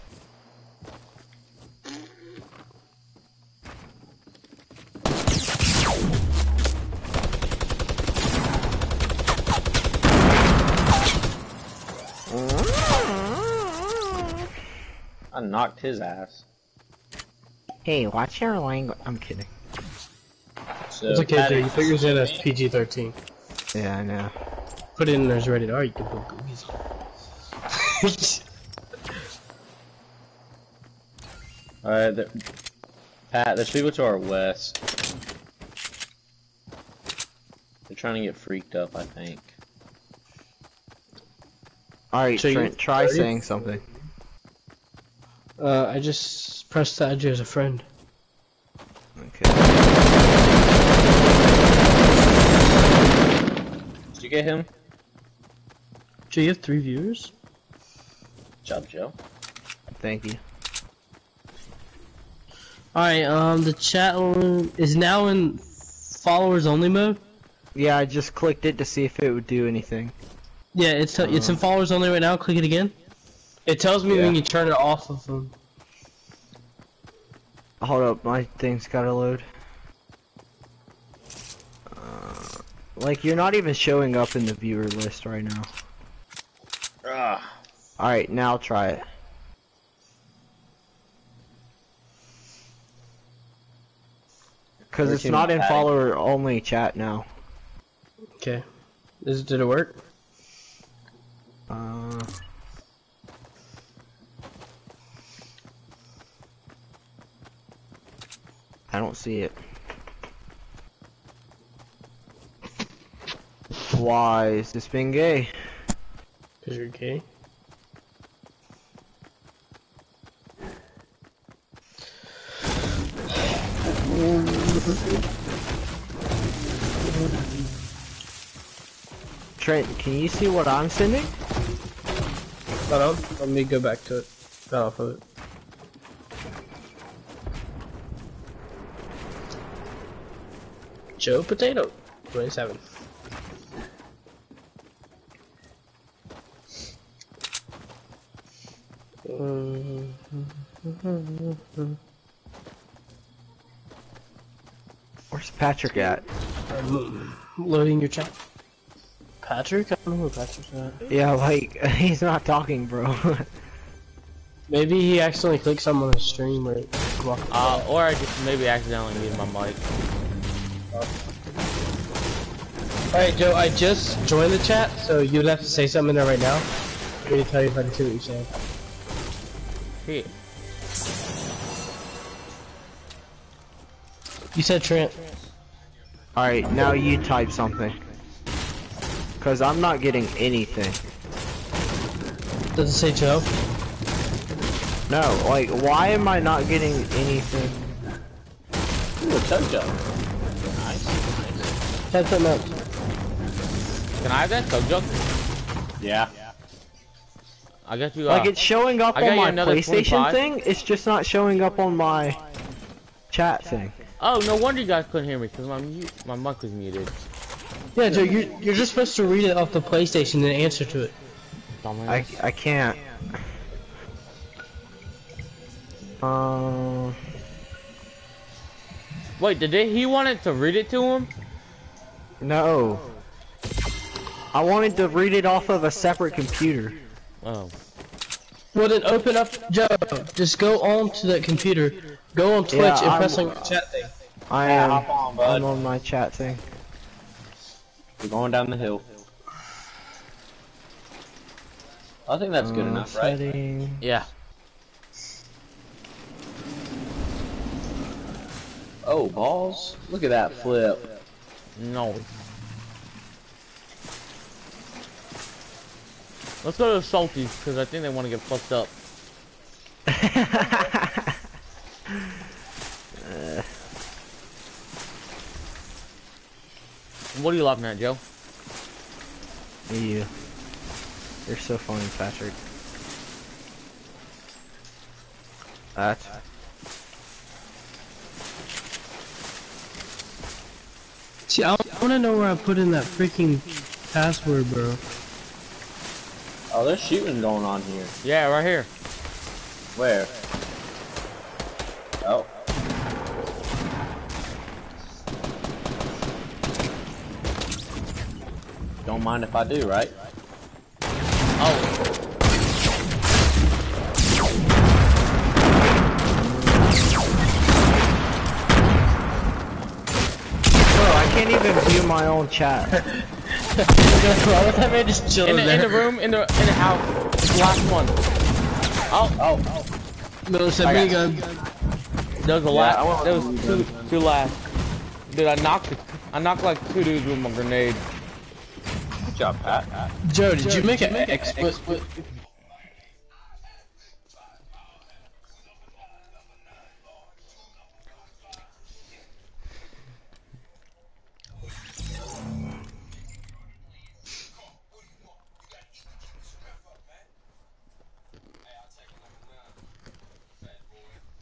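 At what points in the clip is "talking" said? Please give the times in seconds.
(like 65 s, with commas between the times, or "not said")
162 s.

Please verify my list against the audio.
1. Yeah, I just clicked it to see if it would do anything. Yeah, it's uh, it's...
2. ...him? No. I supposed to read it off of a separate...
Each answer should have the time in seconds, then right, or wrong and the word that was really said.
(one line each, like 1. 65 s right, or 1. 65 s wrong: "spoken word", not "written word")
1. 67 s right
2. 231 s wrong: "wanted", not "supposed".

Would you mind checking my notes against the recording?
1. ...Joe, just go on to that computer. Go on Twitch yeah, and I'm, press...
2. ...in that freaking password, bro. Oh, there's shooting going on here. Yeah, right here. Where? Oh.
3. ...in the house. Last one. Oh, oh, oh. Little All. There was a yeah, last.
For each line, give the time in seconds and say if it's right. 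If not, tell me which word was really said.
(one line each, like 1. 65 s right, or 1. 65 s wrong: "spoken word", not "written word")
1. 239 s right
2. 292 s right
3. 326 s wrong: "Samigo", not "All".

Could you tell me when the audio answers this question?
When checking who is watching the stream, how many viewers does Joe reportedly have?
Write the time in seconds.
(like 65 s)
56 s.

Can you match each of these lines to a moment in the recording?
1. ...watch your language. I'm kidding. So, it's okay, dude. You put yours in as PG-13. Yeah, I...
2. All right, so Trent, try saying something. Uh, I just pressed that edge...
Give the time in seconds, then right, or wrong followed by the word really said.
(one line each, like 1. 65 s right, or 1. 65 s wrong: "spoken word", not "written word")
1. 18 s right
2. 42 s right.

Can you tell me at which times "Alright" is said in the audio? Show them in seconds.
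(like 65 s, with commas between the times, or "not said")
62 s, 87 s, 173 s, 186 s.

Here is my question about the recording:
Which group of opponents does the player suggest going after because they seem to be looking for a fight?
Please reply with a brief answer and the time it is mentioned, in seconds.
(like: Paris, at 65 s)
The Salties, at 267 s.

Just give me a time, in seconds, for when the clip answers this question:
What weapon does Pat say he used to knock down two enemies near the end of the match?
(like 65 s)
337 s.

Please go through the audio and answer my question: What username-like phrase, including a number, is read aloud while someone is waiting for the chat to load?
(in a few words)
Joe Potato 27.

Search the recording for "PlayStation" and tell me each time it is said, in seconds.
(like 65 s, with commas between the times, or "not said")
209 s, 219 s.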